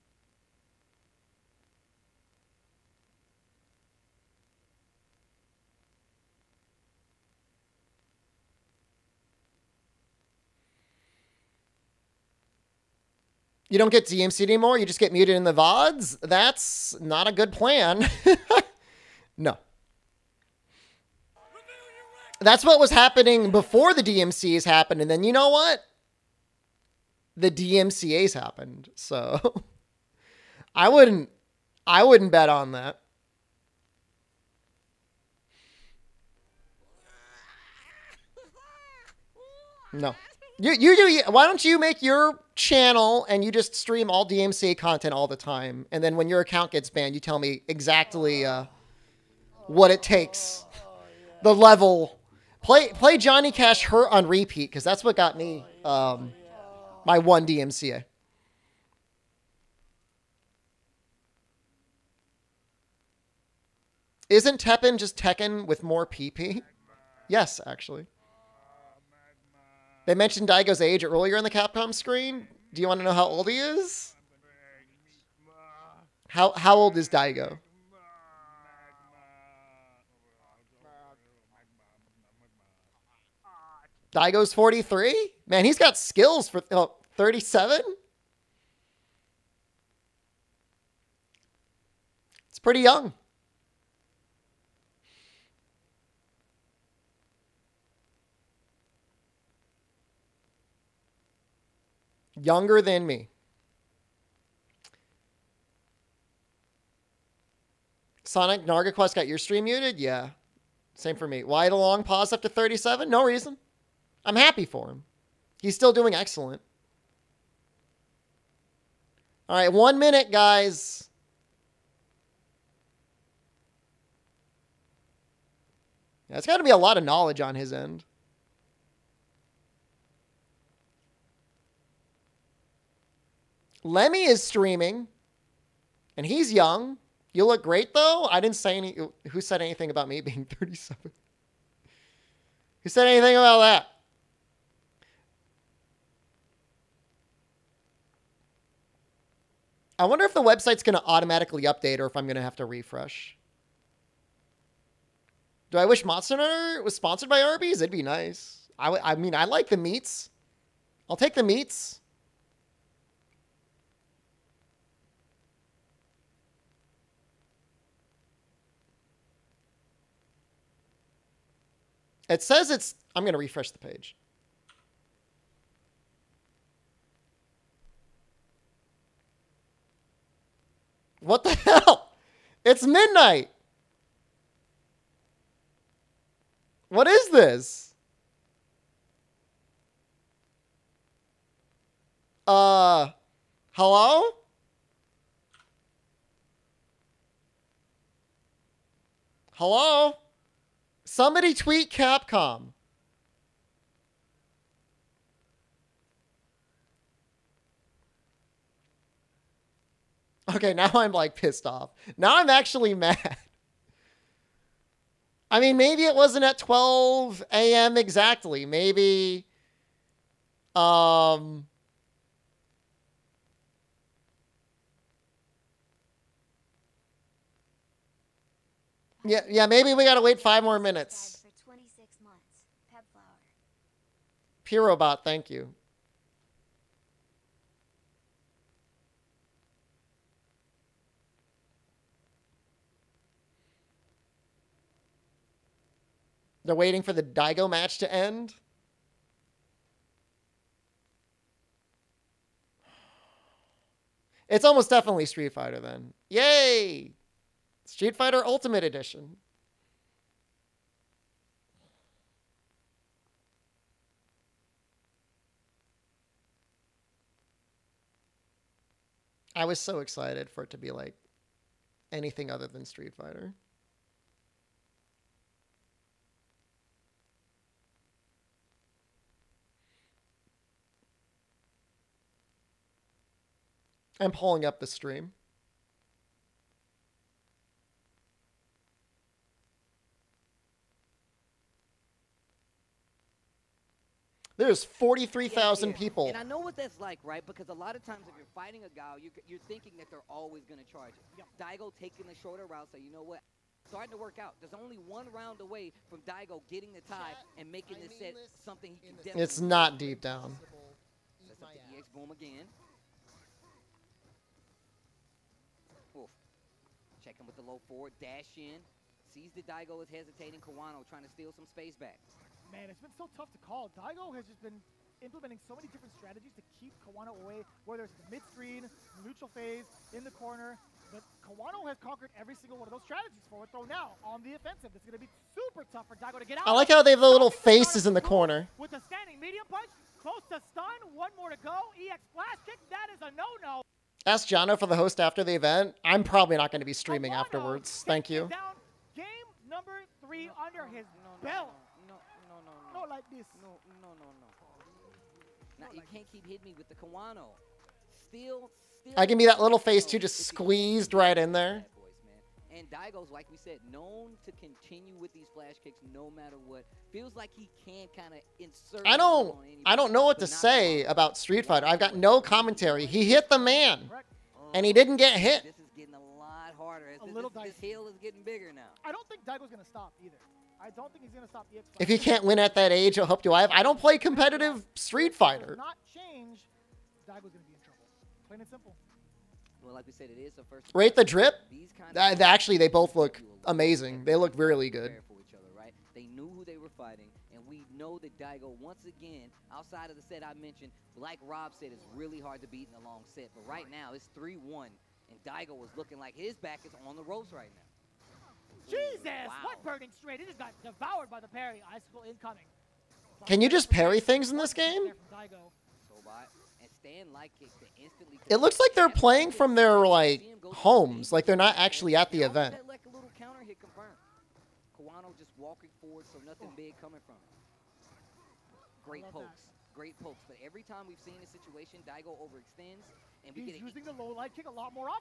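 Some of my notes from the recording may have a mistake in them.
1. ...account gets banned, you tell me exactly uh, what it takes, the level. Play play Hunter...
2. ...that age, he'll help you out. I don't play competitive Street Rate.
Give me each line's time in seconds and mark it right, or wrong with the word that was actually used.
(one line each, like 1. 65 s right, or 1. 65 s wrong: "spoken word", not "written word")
1. 46 s wrong: "Johnny", not "Hunter"
2. 382 s wrong: "Fighter", not "Rate".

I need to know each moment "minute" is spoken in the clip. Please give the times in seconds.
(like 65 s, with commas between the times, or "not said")
119 s, 230 s.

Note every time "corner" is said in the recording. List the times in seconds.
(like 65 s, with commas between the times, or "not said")
330 s, 338 s.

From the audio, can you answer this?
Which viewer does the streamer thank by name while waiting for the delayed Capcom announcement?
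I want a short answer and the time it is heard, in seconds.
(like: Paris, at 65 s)
Pirobot, at 234 s.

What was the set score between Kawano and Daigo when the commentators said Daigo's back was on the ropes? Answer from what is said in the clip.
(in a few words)
3-1.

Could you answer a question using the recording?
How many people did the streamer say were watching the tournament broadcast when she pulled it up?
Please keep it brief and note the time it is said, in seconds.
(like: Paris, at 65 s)
43,000, at 294 s.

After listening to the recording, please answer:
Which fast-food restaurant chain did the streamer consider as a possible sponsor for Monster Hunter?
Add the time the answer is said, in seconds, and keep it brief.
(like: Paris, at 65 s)
Arby's, at 157 s.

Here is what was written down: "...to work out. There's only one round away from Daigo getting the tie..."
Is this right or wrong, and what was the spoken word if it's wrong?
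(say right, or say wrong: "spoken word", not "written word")
right.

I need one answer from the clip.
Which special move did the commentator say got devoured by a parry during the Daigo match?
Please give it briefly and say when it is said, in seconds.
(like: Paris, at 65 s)
burning straight, at 409 s.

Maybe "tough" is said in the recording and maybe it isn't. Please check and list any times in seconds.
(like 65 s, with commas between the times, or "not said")
323 s, 335 s.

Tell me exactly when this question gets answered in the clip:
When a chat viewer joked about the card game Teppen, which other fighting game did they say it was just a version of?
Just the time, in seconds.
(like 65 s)
65 s.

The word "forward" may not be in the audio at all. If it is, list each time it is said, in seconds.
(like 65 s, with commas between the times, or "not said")
317 s, 426 s.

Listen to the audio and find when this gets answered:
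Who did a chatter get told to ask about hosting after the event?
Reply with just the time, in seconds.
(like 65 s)
344 s.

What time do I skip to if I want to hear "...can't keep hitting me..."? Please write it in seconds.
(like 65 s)
356 s.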